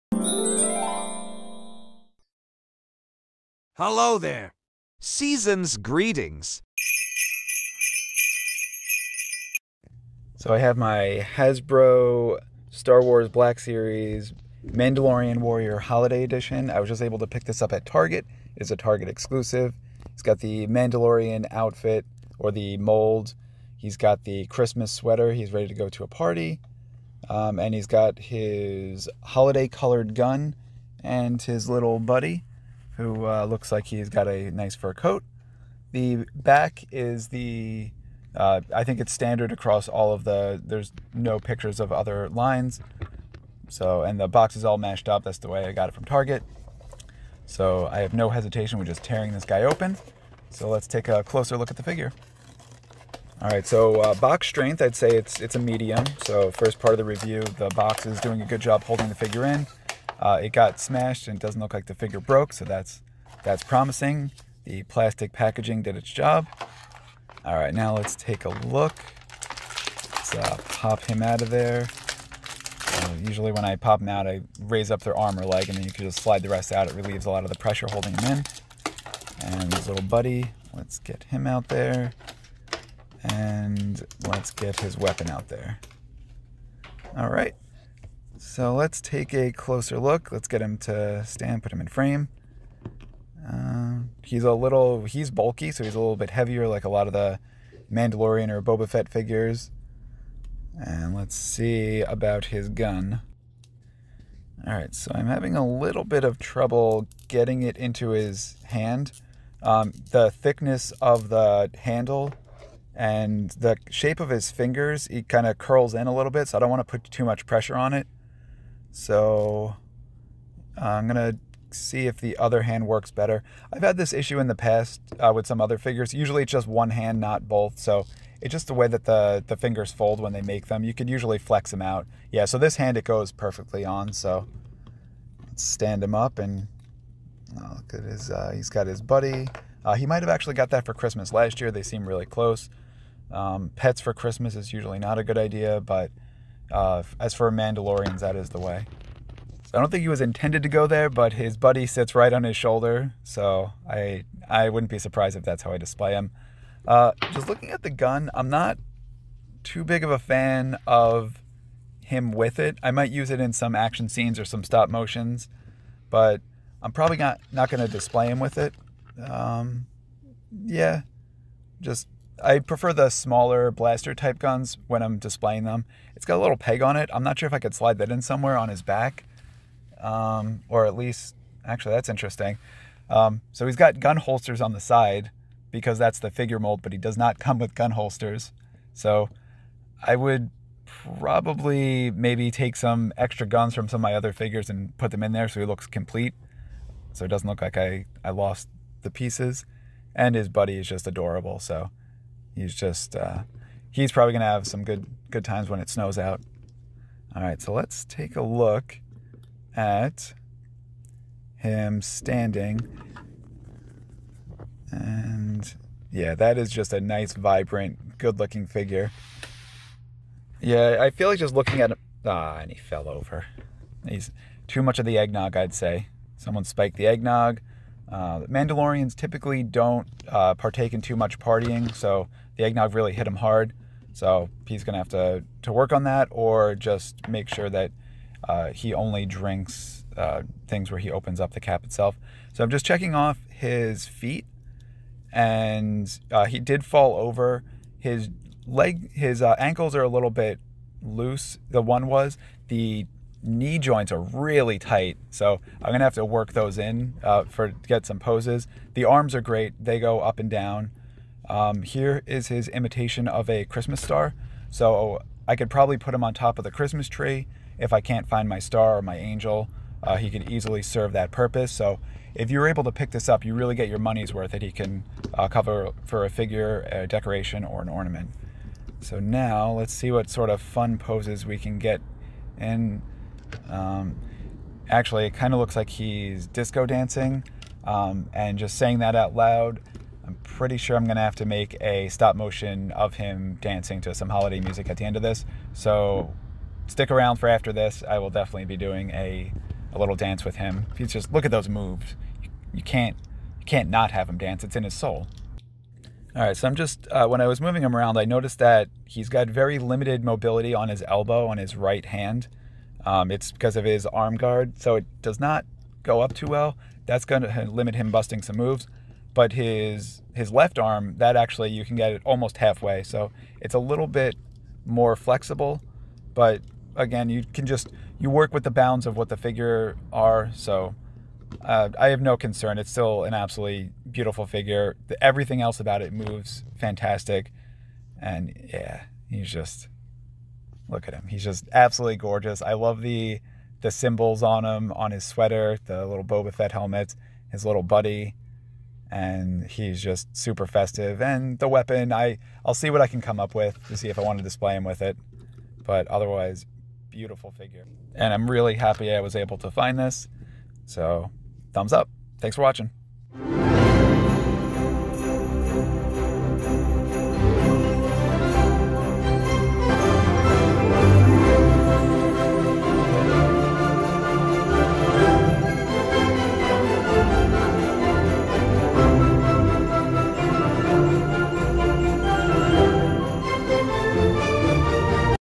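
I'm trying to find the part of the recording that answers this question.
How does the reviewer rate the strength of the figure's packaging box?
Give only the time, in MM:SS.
00:55.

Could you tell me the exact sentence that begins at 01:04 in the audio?
The plastic packaging did its job.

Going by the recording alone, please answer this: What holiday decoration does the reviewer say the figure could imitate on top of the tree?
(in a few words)
Christmas star.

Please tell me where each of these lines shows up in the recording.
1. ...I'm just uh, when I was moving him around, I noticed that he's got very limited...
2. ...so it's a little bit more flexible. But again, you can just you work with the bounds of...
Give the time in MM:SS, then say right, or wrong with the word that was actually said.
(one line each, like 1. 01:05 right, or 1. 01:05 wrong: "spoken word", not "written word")
1. 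05:06 right
2. 05:23 right.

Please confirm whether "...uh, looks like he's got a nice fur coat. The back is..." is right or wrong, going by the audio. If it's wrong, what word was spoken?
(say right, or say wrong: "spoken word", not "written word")
right.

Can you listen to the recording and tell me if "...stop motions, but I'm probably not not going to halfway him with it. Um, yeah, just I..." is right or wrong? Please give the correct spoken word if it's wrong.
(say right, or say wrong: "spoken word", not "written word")
wrong: "display", not "halfway".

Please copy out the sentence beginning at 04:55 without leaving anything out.
So stick around for after this.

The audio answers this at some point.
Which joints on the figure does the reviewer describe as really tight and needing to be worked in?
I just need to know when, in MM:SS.
04:13.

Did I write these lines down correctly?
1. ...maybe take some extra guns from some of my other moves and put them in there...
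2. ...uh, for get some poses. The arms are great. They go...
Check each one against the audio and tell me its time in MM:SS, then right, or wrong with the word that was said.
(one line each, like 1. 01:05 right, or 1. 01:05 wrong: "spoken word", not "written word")
1. 03:12 wrong: "figures", not "moves"
2. 04:17 right.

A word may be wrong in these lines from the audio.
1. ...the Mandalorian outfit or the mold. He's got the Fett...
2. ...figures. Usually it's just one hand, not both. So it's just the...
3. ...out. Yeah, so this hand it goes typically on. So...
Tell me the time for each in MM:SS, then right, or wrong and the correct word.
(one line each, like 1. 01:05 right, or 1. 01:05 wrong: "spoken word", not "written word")
1. 00:20 wrong: "Christmas", not "Fett"
2. 02:05 right
3. 02:11 wrong: "perfectly", not "typically".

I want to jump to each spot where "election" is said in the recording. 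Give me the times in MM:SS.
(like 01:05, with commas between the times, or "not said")
not said.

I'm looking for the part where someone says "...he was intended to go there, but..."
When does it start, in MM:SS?
02:30.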